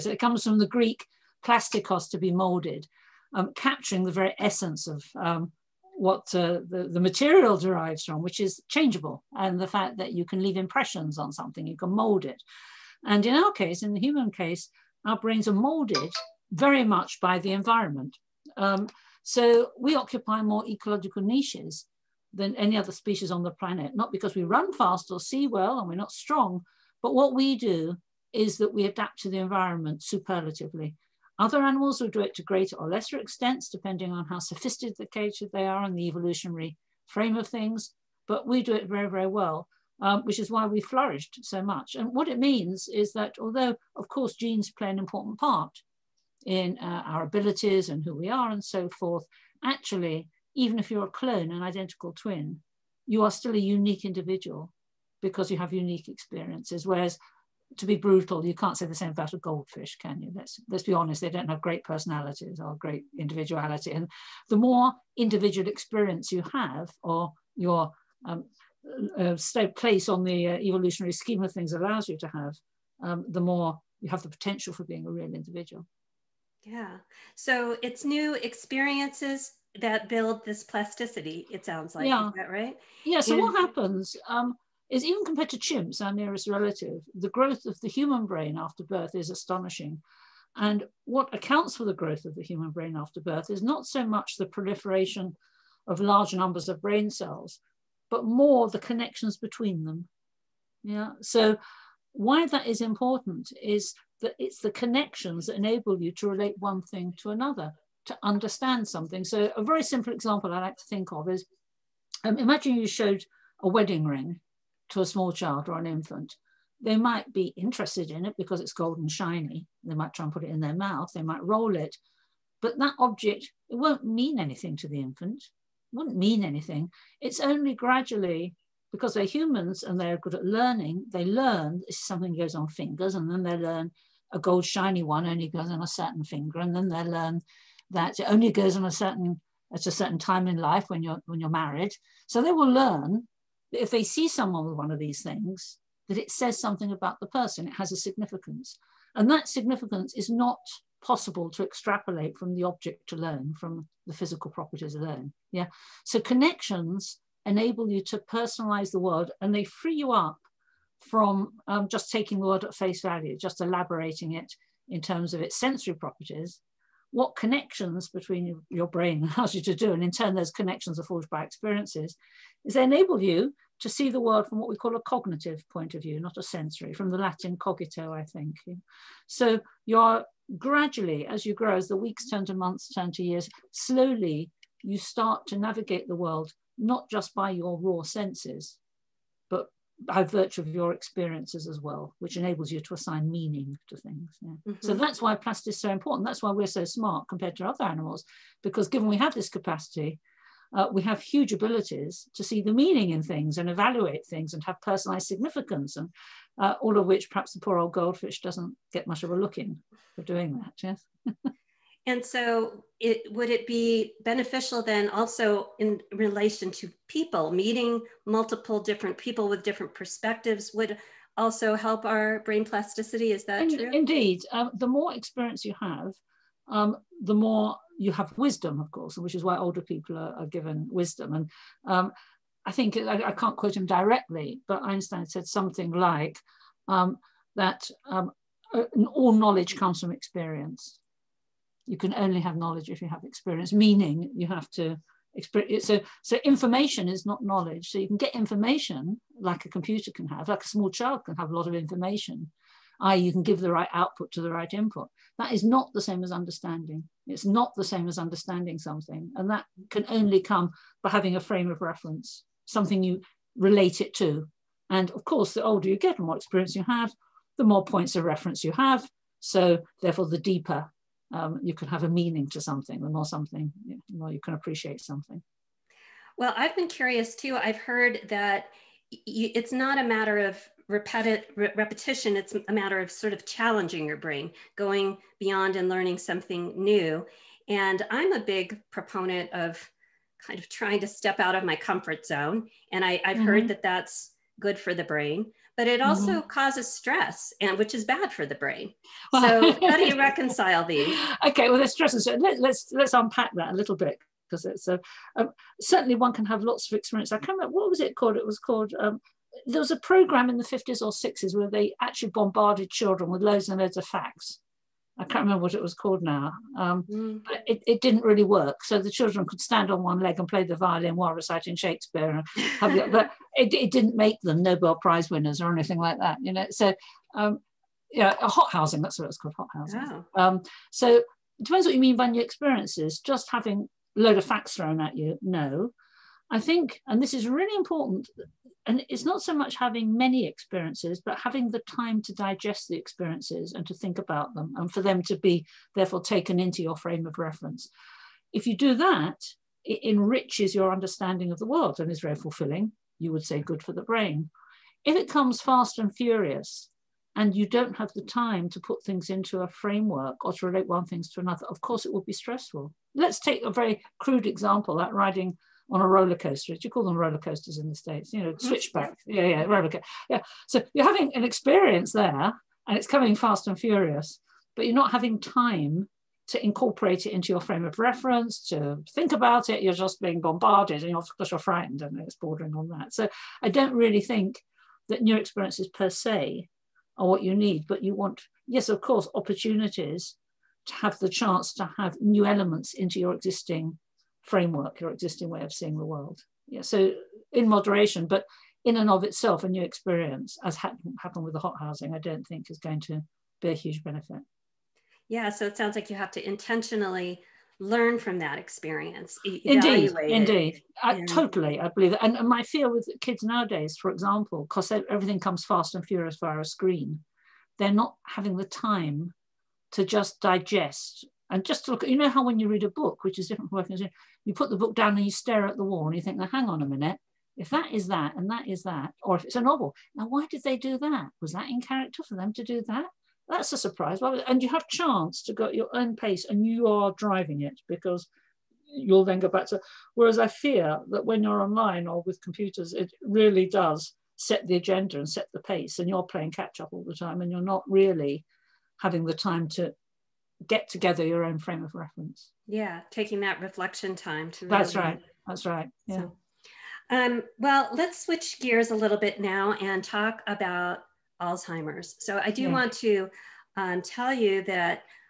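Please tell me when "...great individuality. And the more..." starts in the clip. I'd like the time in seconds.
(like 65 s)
62 s.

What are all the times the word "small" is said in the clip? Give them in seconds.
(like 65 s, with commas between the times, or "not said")
115 s, 250 s.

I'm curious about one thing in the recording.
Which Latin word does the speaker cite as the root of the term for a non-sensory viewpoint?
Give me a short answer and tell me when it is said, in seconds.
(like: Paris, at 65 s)
cogito, at 177 s.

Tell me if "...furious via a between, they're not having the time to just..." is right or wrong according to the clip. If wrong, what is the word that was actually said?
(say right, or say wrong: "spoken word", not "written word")
wrong: "screen", not "between".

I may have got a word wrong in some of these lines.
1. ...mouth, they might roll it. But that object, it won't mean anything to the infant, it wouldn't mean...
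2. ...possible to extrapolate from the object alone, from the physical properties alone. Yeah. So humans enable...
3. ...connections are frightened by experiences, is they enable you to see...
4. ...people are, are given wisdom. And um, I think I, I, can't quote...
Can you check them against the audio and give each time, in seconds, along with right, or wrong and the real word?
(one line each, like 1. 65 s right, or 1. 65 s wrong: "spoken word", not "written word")
1. 120 s right
2. 151 s wrong: "connections", not "humans"
3. 170 s wrong: "forged", not "frightened"
4. 229 s right.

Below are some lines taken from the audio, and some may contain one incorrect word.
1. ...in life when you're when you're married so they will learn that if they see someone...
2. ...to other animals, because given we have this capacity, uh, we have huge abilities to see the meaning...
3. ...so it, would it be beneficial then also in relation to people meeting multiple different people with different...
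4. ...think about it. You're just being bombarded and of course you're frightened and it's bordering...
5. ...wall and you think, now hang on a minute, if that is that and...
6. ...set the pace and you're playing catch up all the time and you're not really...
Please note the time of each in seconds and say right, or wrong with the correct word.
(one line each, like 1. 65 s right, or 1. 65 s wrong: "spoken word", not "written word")
1. 140 s right
2. 197 s right
3. 212 s right
4. 379 s right
5. 425 s right
6. 445 s right.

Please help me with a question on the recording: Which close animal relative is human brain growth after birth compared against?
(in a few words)
chimps.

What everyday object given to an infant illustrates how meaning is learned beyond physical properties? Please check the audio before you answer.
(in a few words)
wedding ring.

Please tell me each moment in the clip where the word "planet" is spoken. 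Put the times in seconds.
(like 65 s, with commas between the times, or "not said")
23 s.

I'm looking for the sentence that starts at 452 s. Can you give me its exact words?
Yeah, taking that reflection time to.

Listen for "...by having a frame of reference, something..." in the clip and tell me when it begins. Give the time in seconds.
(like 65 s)
261 s.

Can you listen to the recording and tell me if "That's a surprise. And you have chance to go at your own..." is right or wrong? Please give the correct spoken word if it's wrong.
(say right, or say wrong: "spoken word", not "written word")
right.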